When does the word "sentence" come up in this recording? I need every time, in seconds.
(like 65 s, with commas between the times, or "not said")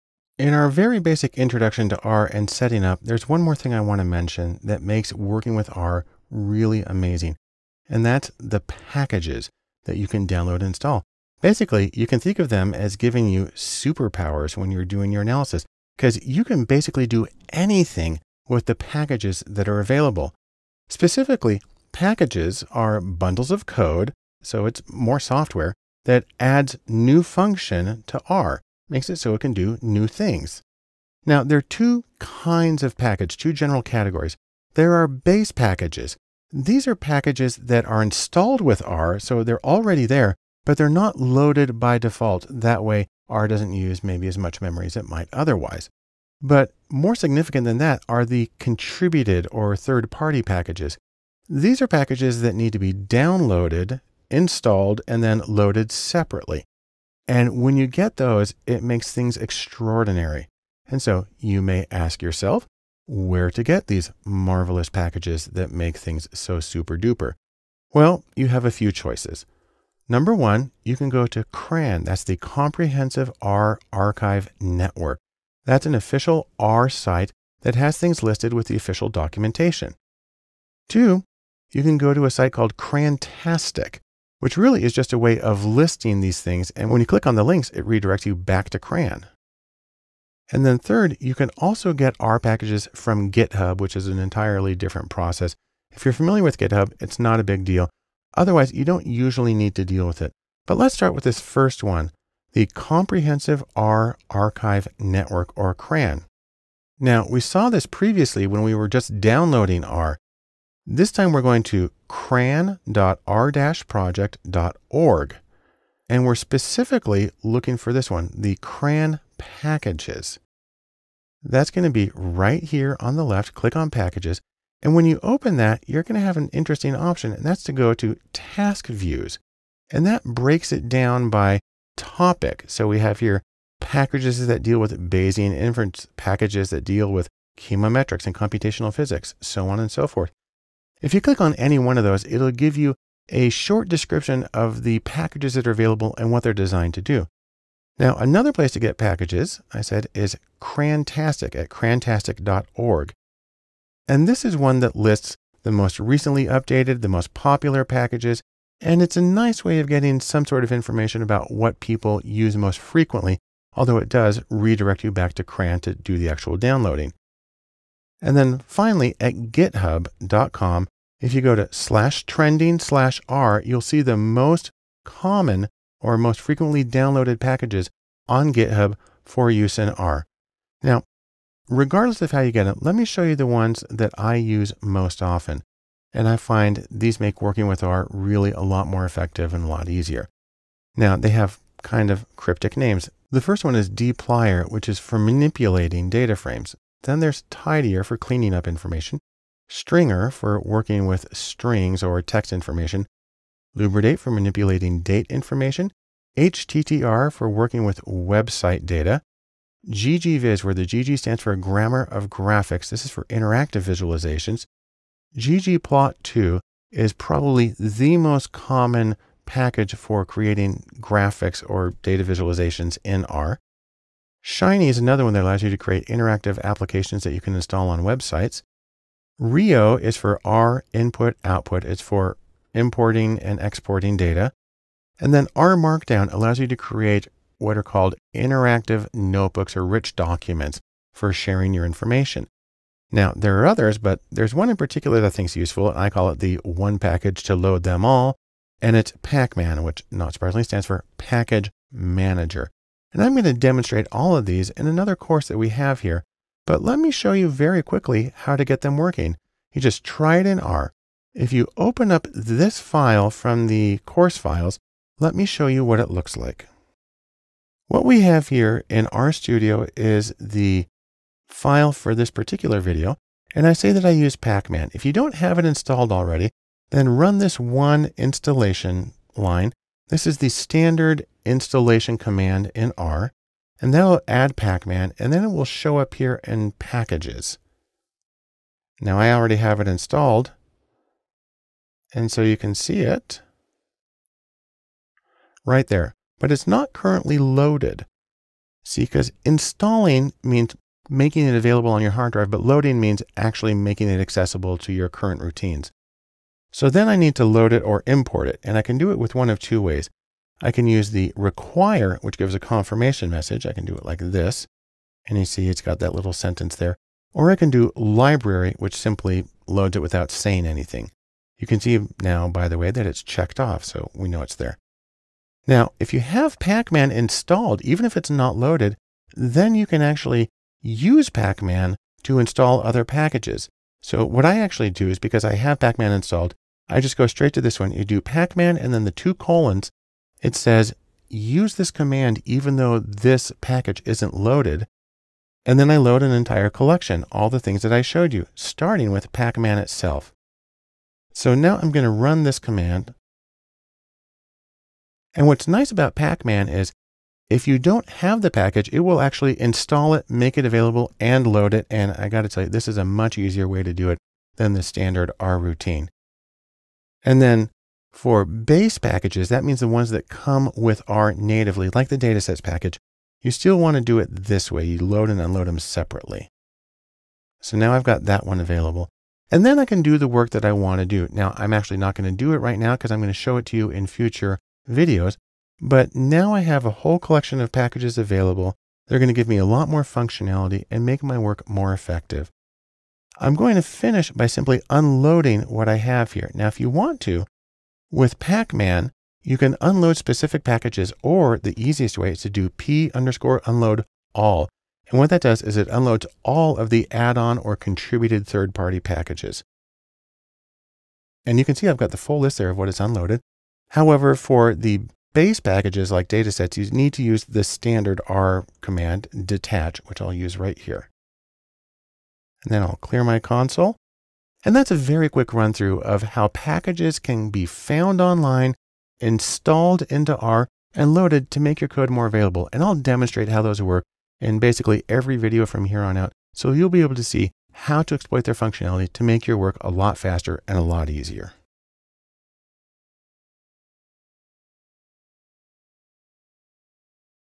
316 s.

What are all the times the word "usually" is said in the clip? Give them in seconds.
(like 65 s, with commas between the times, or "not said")
99 s.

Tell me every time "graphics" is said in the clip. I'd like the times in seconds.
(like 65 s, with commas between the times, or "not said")
212 s, 220 s.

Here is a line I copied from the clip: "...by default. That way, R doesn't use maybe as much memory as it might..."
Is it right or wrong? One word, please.
right.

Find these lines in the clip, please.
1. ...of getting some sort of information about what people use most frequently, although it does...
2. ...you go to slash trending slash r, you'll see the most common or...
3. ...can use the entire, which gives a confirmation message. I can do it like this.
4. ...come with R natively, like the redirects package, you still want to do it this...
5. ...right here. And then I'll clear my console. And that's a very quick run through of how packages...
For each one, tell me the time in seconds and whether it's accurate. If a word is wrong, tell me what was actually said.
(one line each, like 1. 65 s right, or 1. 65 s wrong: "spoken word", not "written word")
1. 159 s right
2. 171 s right
3. 310 s wrong: "require", not "entire"
4. 370 s wrong: "datasets", not "redirects"
5. 420 s right.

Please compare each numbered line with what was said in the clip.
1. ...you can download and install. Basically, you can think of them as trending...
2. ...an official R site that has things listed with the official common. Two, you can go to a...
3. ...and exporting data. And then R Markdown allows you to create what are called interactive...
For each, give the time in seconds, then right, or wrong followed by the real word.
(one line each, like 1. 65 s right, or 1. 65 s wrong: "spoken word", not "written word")
1. 9 s wrong: "giving", not "trending"
2. 75 s wrong: "documentation", not "common"
3. 233 s right.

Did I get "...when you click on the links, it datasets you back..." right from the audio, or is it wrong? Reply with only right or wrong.
wrong.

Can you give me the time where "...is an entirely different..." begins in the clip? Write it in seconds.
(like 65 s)
93 s.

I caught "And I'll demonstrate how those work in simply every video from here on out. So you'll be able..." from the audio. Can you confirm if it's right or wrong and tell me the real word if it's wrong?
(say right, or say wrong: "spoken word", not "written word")
wrong: "basically", not "simply".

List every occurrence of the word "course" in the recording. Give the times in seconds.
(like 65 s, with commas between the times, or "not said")
255 s, 264 s.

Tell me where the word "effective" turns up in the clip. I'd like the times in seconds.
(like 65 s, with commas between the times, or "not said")
189 s, 391 s.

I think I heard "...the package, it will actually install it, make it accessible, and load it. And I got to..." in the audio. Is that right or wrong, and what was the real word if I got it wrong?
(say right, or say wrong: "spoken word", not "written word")
wrong: "available", not "accessible".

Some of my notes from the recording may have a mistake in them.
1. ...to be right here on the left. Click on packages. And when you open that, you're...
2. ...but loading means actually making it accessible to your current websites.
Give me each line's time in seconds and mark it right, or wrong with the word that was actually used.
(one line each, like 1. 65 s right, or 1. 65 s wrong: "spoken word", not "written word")
1. 121 s right
2. 302 s wrong: "routines", not "websites".